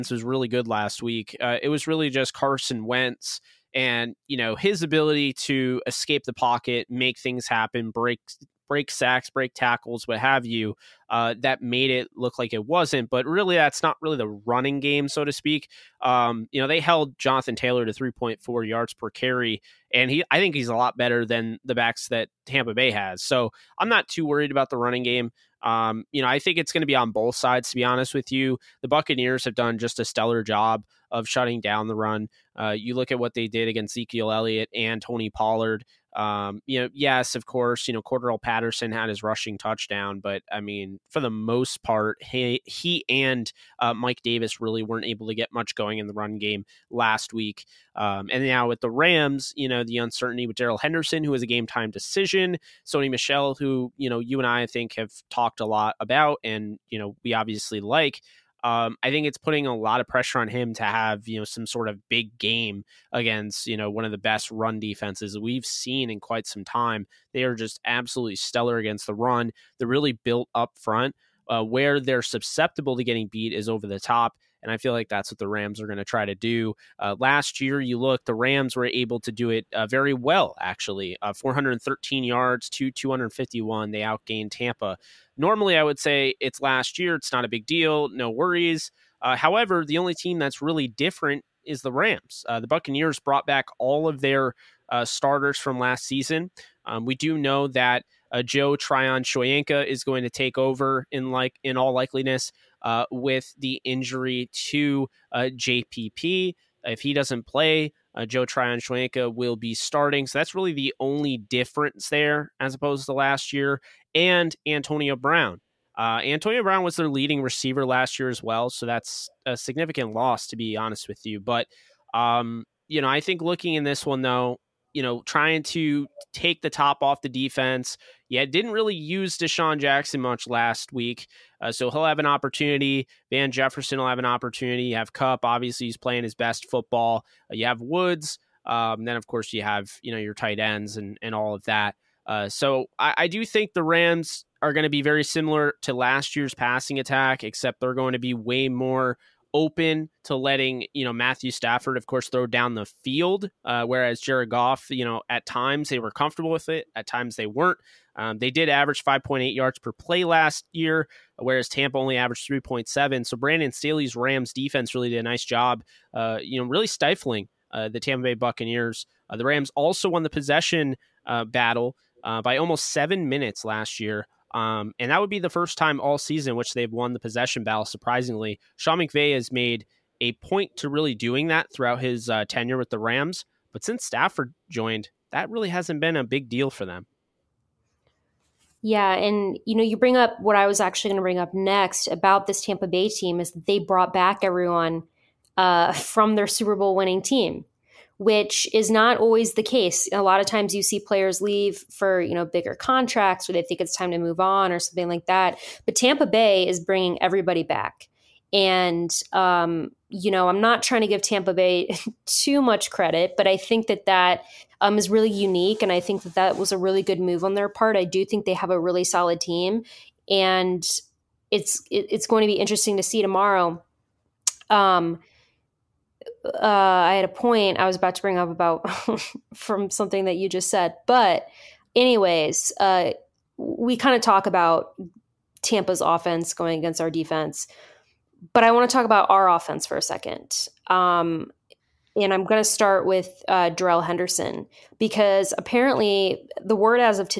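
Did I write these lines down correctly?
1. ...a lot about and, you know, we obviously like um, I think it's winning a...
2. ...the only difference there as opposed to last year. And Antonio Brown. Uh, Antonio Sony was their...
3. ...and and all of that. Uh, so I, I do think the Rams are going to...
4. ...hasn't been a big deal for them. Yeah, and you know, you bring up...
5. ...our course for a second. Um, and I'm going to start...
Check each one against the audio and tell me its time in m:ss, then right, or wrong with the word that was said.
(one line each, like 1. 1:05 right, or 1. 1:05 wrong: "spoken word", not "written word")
1. 0:55 wrong: "putting", not "winning"
2. 1:50 wrong: "Brown", not "Sony"
3. 2:20 right
4. 3:05 right
5. 3:59 wrong: "offense", not "course".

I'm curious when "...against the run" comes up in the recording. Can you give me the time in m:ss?
1:08.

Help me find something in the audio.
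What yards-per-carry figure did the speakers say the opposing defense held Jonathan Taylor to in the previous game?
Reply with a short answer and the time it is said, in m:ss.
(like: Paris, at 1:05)
3.4, at 0:17.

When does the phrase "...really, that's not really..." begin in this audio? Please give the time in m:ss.
0:13.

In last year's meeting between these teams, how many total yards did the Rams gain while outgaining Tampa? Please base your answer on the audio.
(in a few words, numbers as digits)
413.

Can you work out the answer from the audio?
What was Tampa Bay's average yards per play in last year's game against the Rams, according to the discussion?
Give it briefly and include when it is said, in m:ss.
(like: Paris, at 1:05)
3.7, at 2:42.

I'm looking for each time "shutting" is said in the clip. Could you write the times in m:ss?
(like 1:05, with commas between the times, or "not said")
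0:31.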